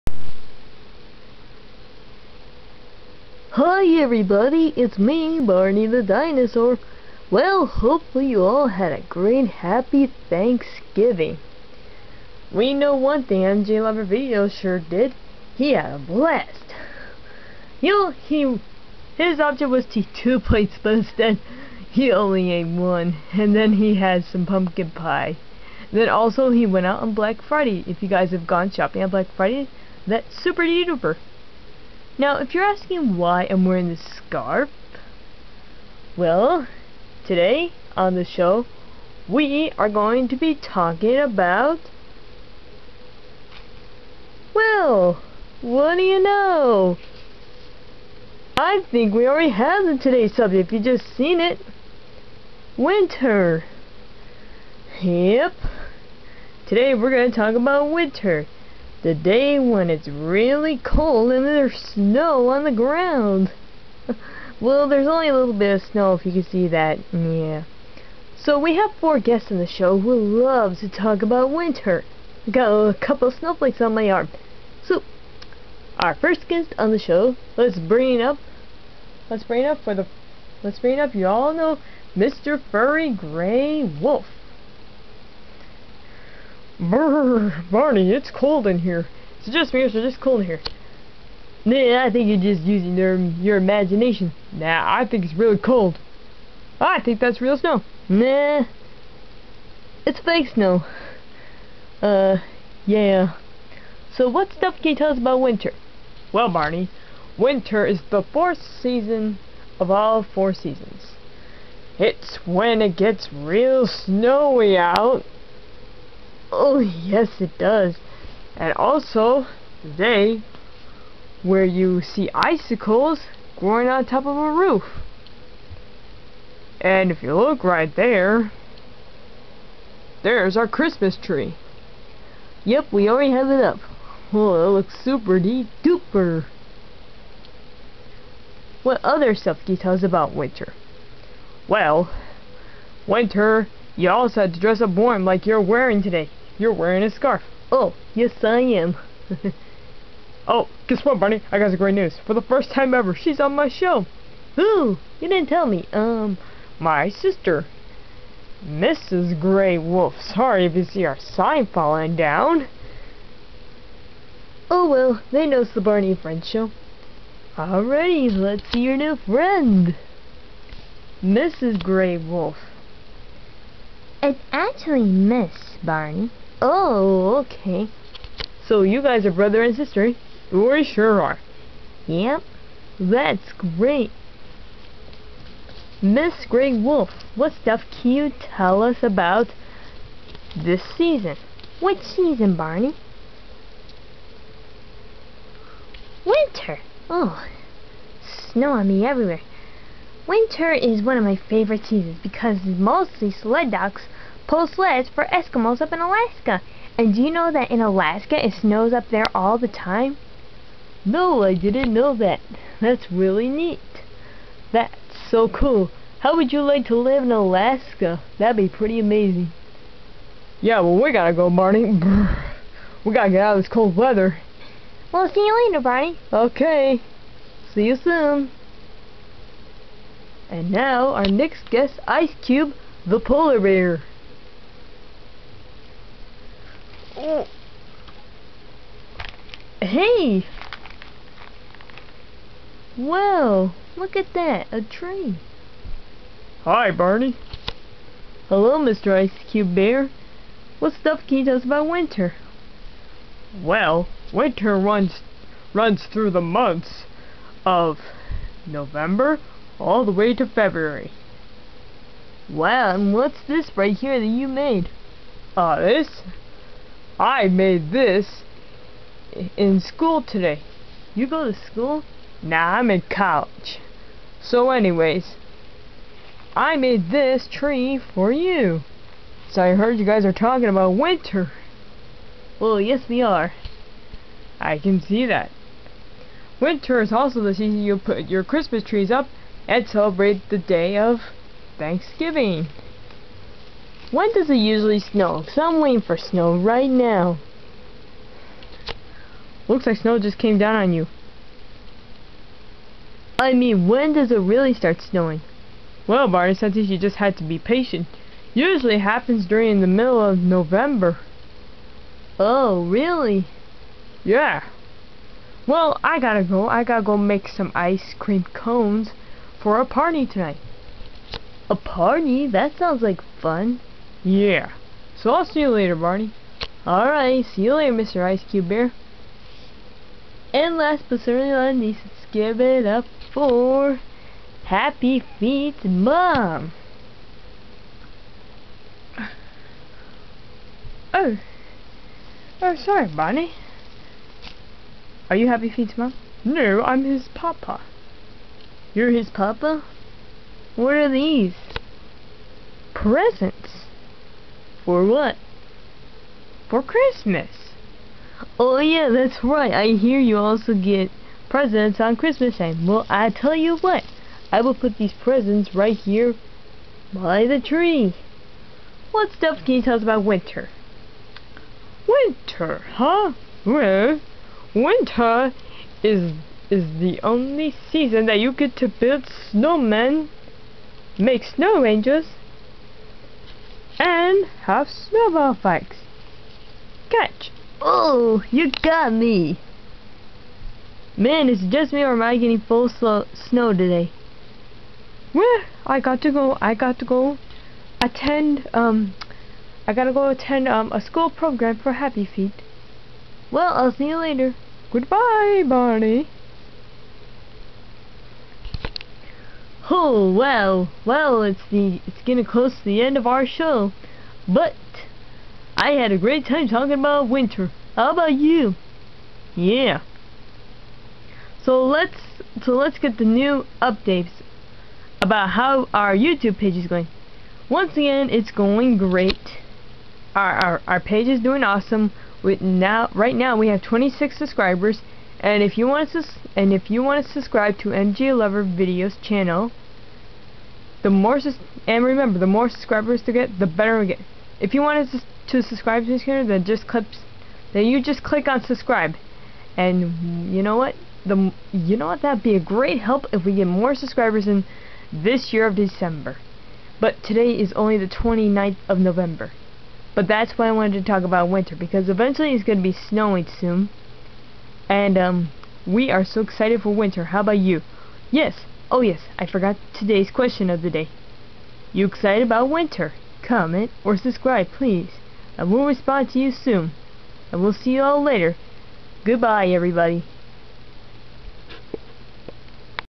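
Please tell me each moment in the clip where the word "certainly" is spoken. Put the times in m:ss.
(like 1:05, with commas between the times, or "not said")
5:31.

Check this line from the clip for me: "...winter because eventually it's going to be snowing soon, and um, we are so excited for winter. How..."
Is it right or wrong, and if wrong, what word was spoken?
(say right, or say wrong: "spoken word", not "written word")
right.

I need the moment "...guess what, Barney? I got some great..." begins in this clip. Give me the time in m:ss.
2:30.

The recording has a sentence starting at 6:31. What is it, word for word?
Man, is it just me or am I getting full snow today?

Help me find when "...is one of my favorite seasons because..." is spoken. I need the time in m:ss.
3:20.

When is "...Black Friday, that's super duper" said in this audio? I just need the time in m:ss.
0:29.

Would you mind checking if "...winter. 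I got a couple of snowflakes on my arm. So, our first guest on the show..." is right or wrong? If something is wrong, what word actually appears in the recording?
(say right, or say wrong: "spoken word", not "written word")
right.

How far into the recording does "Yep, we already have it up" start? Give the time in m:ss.
2:12.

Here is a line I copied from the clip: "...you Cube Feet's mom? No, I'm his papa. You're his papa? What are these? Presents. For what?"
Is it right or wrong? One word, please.
wrong.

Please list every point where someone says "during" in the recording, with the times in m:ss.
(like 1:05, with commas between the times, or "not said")
5:09.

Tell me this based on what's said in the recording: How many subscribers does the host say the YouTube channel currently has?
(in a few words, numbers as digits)
26.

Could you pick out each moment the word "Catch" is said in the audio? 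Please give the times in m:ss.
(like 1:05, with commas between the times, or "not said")
6:27.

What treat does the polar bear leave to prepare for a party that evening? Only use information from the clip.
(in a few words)
Ice cream cones.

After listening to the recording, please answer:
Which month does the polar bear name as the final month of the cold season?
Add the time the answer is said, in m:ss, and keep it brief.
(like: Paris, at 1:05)
February, at 4:20.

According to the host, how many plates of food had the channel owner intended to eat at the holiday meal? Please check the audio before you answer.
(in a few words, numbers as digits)
2.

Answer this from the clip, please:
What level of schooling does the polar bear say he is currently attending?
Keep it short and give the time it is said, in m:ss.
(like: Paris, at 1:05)
College, at 4:33.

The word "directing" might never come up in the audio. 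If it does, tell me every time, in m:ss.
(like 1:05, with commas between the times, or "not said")
not said.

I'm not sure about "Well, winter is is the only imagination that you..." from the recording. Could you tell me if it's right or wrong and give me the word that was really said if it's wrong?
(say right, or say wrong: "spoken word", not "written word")
wrong: "season", not "imagination".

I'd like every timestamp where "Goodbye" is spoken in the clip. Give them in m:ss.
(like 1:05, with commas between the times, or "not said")
6:44, 7:59.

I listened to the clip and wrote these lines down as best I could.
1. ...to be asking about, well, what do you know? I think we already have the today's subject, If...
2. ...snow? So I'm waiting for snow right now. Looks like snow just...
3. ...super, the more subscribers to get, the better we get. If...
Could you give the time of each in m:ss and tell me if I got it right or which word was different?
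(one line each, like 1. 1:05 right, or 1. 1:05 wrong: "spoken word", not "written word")
1. 0:40 wrong: "talking", not "asking"
2. 4:54 right
3. 7:22 wrong: "remember", not "super".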